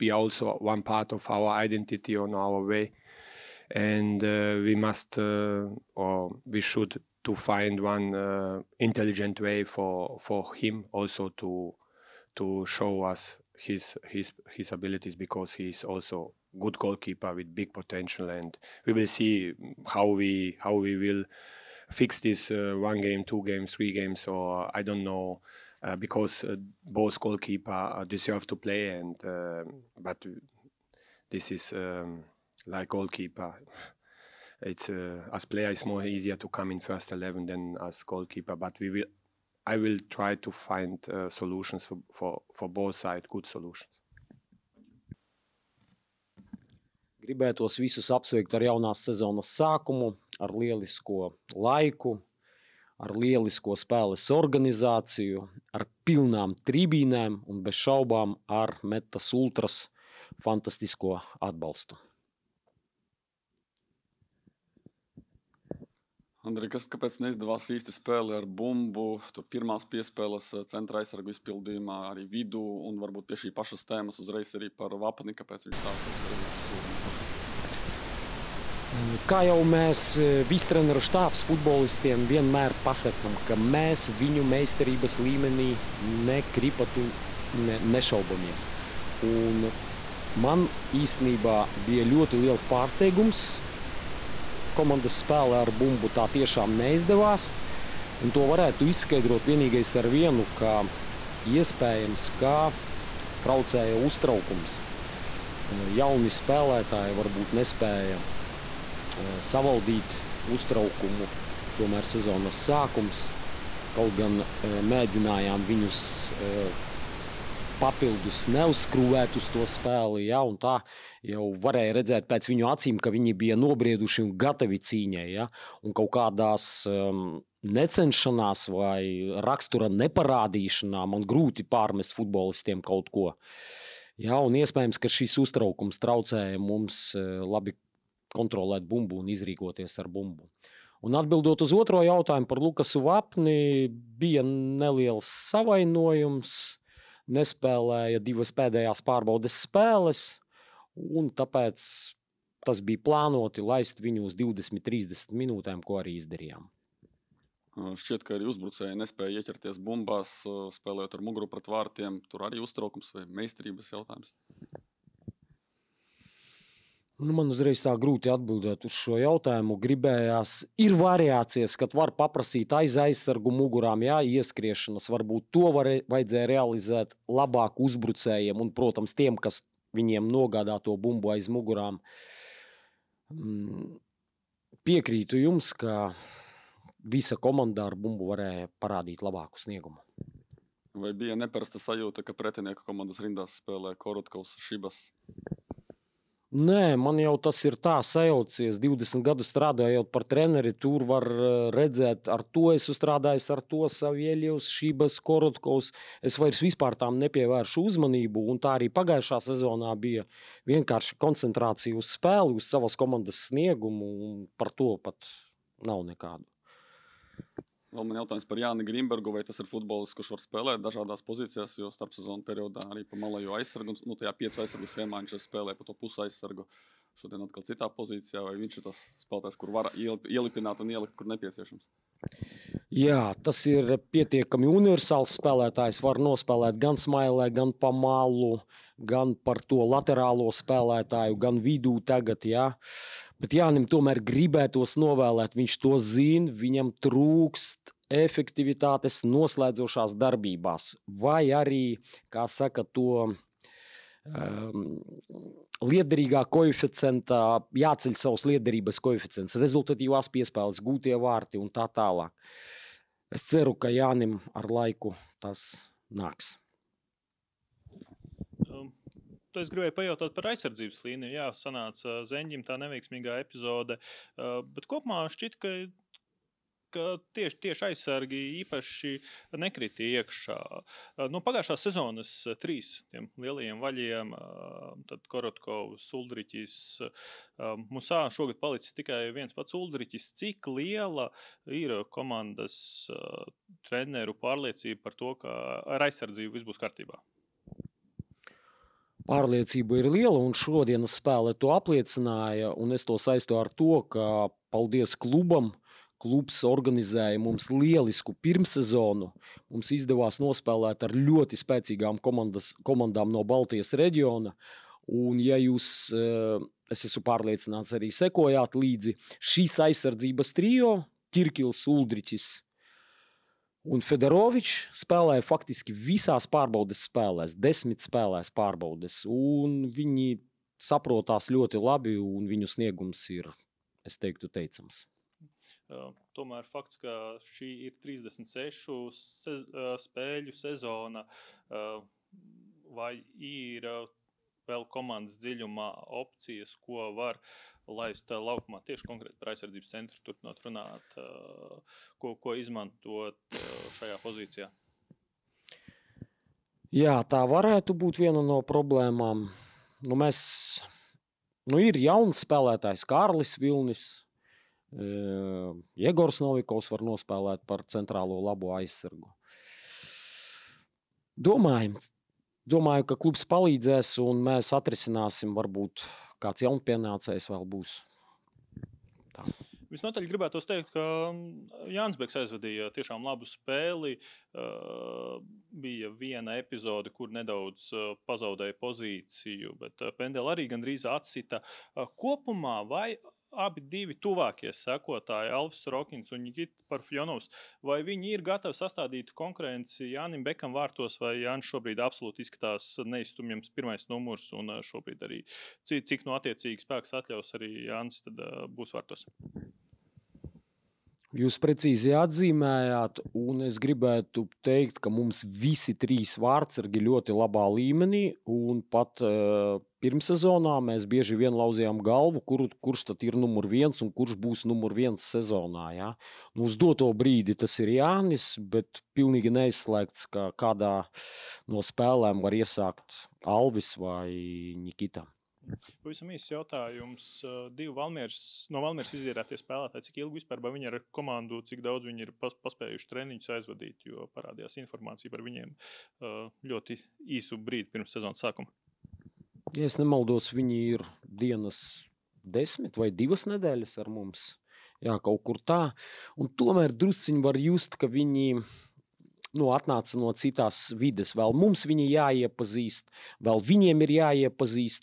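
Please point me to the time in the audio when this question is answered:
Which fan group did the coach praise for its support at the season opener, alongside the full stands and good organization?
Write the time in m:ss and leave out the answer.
0:58.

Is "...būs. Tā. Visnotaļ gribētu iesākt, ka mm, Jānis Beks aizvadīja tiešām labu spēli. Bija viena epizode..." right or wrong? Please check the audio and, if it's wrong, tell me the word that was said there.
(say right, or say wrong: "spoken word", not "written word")
wrong: "teikt", not "iesākt".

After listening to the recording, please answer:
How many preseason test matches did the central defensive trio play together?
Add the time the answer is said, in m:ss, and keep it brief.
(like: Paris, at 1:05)
10, at 5:27.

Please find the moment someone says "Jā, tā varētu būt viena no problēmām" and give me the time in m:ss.
5:56.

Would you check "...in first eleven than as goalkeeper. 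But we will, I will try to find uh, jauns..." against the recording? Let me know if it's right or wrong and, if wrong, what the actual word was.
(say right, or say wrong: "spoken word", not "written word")
wrong: "solutions", not "jauns".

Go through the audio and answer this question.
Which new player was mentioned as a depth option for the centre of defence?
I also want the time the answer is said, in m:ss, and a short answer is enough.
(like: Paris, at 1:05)
Kārlis Vilnis, at 6:03.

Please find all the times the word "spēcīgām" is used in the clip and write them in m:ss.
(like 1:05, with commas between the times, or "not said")
5:11.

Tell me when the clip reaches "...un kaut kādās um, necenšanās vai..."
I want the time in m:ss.
2:05.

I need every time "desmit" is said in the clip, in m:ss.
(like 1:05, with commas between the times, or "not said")
5:27, 7:32.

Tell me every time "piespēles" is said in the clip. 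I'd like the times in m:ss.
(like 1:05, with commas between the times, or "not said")
1:09, 4:20.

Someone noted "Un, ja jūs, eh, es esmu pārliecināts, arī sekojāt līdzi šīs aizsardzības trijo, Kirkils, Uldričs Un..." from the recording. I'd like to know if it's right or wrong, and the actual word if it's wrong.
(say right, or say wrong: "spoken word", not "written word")
right.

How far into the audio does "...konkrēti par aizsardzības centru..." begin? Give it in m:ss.
5:49.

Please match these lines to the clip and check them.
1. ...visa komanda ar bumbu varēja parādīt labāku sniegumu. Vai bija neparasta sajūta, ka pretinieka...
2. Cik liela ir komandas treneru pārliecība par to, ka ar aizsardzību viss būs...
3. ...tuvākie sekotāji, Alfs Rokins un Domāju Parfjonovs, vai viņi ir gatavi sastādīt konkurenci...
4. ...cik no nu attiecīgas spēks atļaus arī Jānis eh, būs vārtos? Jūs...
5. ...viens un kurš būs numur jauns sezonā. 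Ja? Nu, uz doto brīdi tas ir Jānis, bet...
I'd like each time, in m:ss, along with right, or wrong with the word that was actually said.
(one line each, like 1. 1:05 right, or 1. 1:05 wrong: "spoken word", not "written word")
1. 3:07 right
2. 4:50 right
3. 6:34 wrong: "Nikita", not "Domāju"
4. 6:46 right
5. 7:03 wrong: "viens", not "jauns".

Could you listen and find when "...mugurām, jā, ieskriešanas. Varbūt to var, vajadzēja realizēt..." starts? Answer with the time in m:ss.
2:53.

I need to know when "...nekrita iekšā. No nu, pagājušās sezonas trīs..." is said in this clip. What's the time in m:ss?
4:39.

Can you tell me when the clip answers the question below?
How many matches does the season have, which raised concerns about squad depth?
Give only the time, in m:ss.
5:38.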